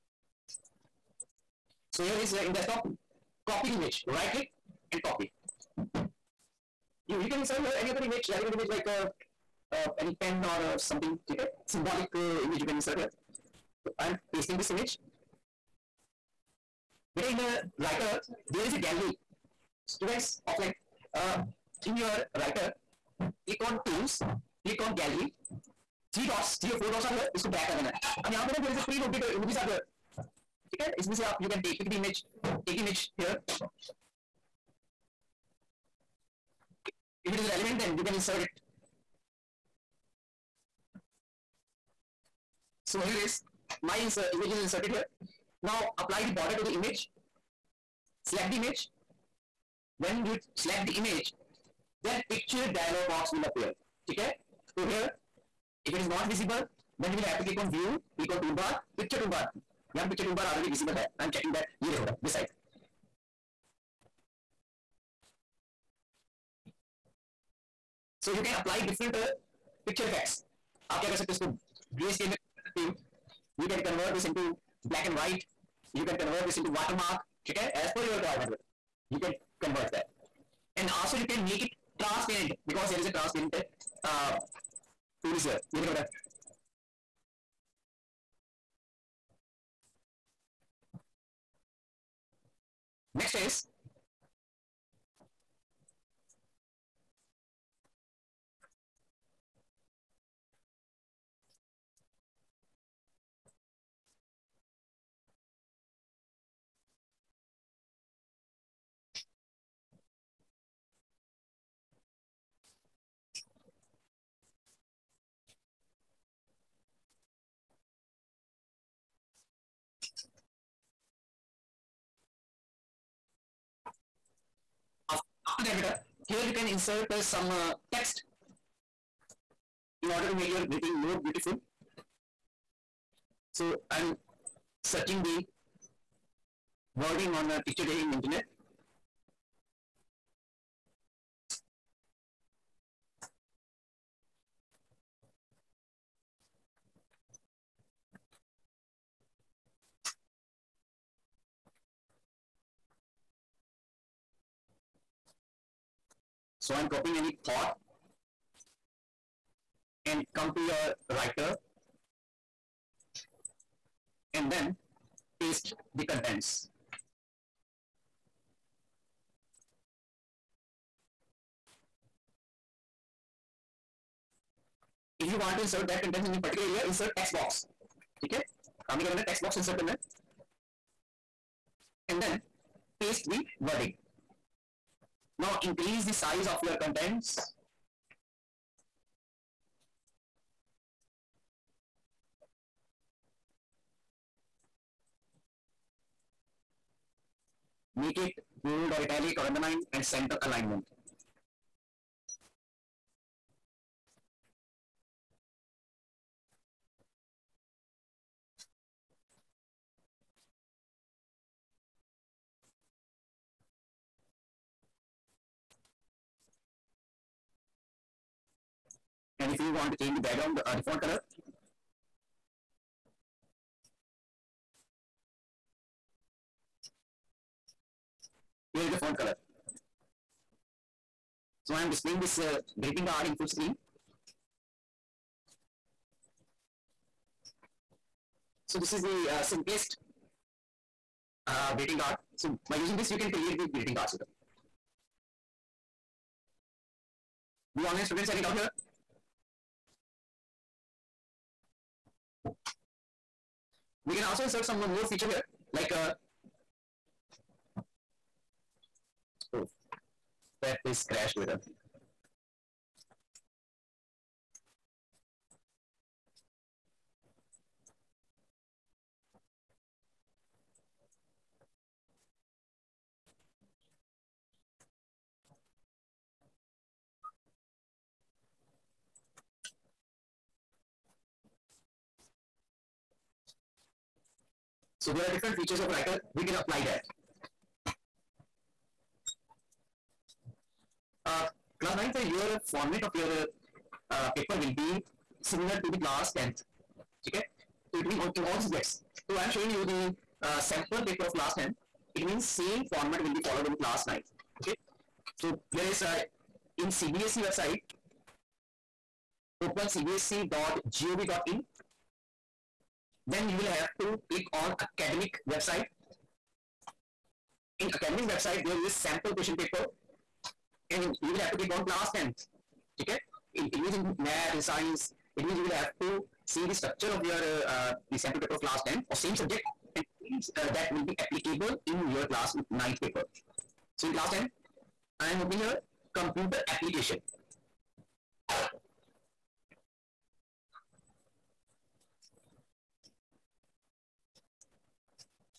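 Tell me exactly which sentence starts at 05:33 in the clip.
So in class 10, I am opening your computer application.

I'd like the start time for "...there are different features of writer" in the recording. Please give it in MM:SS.
04:45.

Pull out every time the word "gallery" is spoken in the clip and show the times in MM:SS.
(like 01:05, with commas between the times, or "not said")
00:18, 00:25.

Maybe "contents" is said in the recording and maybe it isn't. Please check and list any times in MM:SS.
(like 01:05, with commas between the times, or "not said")
02:46, 02:56, 03:06.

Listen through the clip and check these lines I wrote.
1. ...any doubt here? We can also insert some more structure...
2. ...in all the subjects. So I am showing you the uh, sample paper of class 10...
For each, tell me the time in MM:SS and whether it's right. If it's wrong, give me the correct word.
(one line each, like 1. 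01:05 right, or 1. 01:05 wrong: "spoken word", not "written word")
1. 04:08 wrong: "feature", not "structure"
2. 04:58 right.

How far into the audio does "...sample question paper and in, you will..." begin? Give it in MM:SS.
05:18.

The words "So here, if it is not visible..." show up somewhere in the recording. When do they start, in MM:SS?
00:54.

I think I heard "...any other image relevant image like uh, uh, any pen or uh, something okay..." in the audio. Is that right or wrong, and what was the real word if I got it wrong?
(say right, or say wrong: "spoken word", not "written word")
right.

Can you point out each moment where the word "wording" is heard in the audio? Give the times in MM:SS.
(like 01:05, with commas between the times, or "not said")
02:16, 03:03.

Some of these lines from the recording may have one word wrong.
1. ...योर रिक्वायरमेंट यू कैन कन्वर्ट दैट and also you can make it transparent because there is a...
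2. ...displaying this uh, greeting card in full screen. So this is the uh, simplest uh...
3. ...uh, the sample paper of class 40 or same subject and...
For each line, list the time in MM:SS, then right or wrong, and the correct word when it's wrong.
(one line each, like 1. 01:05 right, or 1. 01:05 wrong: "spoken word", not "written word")
1. 01:18 right
2. 03:51 right
3. 05:27 wrong: "10", not "40".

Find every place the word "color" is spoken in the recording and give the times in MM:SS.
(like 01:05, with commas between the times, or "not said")
03:41, 03:49.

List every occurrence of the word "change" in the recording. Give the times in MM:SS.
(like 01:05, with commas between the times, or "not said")
03:39.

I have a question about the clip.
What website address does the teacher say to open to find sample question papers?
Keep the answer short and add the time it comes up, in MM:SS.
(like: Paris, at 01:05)
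cbse.gov.in, at 05:09.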